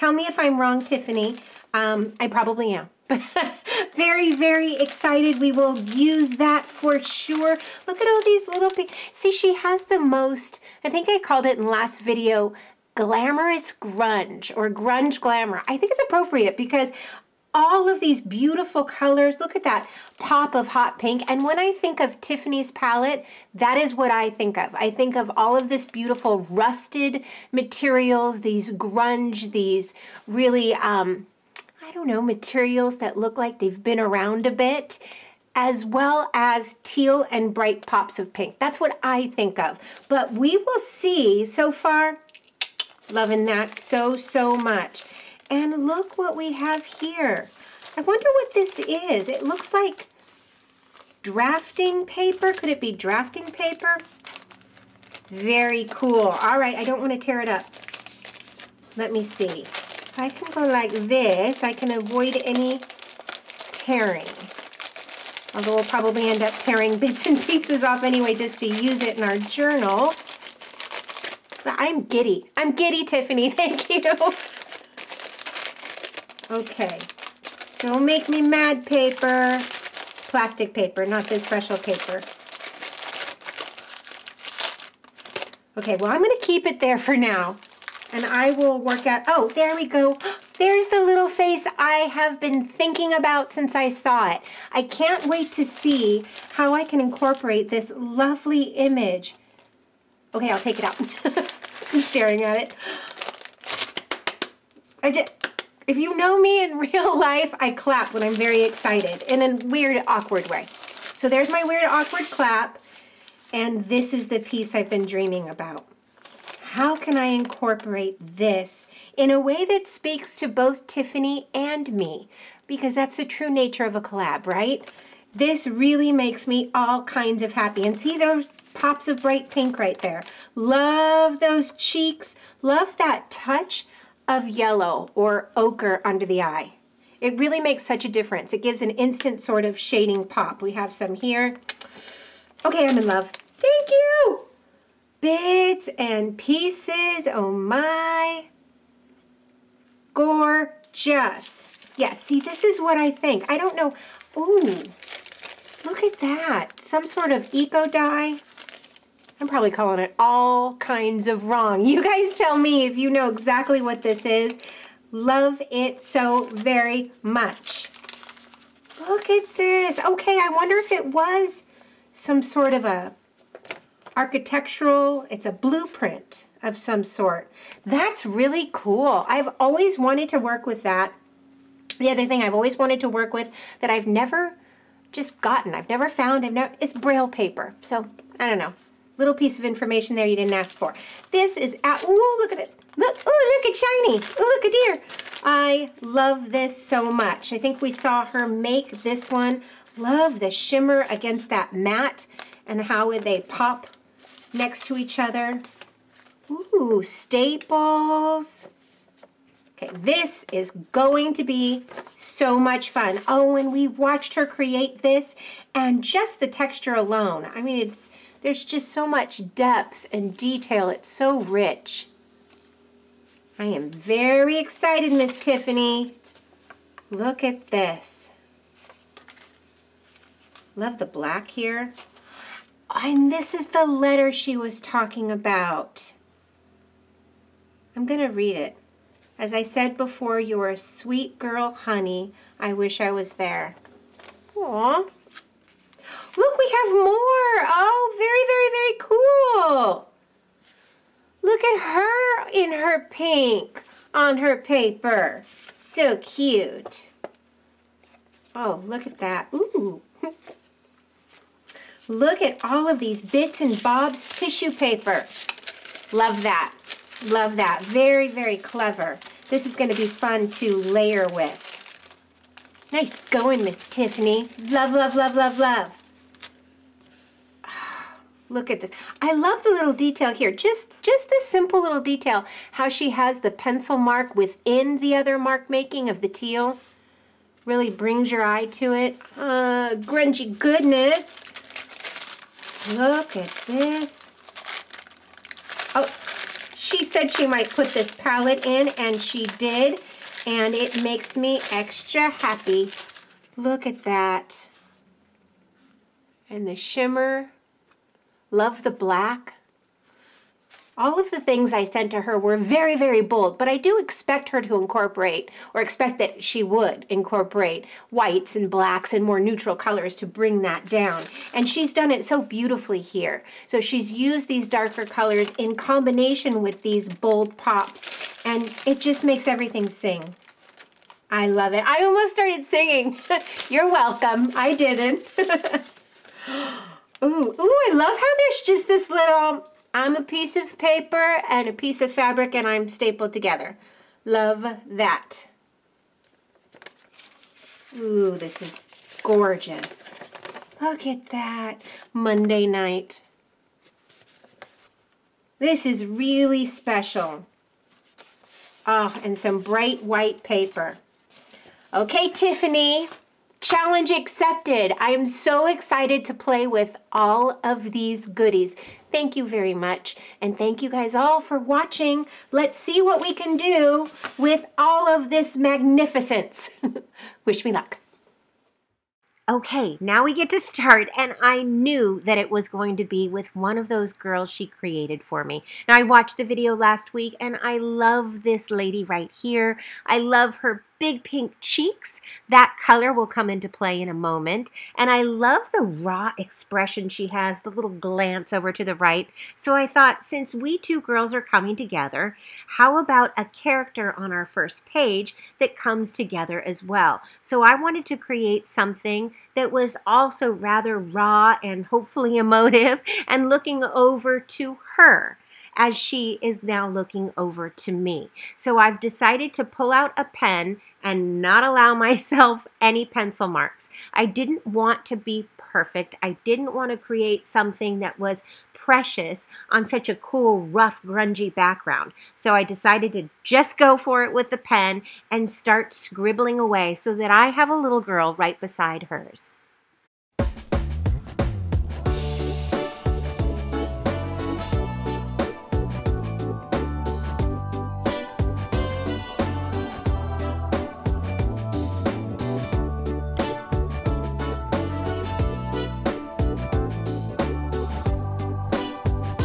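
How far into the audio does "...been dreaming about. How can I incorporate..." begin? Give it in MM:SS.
01:54.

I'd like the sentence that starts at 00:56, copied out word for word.
All right, I don't want to tear it up.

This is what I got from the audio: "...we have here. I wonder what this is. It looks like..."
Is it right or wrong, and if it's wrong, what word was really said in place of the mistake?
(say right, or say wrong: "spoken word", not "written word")
right.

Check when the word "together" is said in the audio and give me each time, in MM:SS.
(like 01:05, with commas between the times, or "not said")
05:43, 06:41, 06:46.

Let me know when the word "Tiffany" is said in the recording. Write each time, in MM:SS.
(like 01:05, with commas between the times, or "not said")
00:00, 00:22, 01:13, 02:00, 03:45, 04:33, 06:02.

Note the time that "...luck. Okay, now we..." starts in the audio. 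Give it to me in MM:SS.
06:17.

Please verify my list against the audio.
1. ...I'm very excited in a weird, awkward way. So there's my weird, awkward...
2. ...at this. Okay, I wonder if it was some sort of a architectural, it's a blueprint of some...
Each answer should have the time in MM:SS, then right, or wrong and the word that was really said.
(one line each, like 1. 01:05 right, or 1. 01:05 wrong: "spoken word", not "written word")
1. 01:48 right
2. 02:49 right.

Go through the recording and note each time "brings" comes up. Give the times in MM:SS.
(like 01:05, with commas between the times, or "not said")
04:47, 05:20.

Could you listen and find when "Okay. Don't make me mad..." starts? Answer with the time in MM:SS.
01:16.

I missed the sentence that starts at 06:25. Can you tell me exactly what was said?
Now, I watched the video last week, and I love this lady right here.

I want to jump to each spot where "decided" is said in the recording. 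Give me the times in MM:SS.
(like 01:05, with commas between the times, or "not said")
06:58, 07:12.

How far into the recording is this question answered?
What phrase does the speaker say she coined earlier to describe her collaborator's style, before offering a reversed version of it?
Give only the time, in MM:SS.
00:12.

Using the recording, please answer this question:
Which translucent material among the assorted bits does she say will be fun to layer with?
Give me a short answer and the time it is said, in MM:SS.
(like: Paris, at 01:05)
tissue paper, at 04:24.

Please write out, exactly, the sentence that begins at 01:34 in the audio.
I can't wait to see how I can incorporate this lovely image.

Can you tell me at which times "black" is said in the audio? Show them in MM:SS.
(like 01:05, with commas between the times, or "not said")
03:51, 05:08, 05:18.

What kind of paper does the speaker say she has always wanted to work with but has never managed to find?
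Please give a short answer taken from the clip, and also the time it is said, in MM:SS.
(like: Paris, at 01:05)
braille paper, at 03:06.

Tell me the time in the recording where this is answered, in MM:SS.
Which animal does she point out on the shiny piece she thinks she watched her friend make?
03:14.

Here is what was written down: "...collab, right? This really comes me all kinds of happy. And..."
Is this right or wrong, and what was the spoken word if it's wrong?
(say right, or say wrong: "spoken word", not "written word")
wrong: "makes", not "comes".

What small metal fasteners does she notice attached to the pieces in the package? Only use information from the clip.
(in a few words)
staples.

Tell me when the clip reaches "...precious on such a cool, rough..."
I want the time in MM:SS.
07:08.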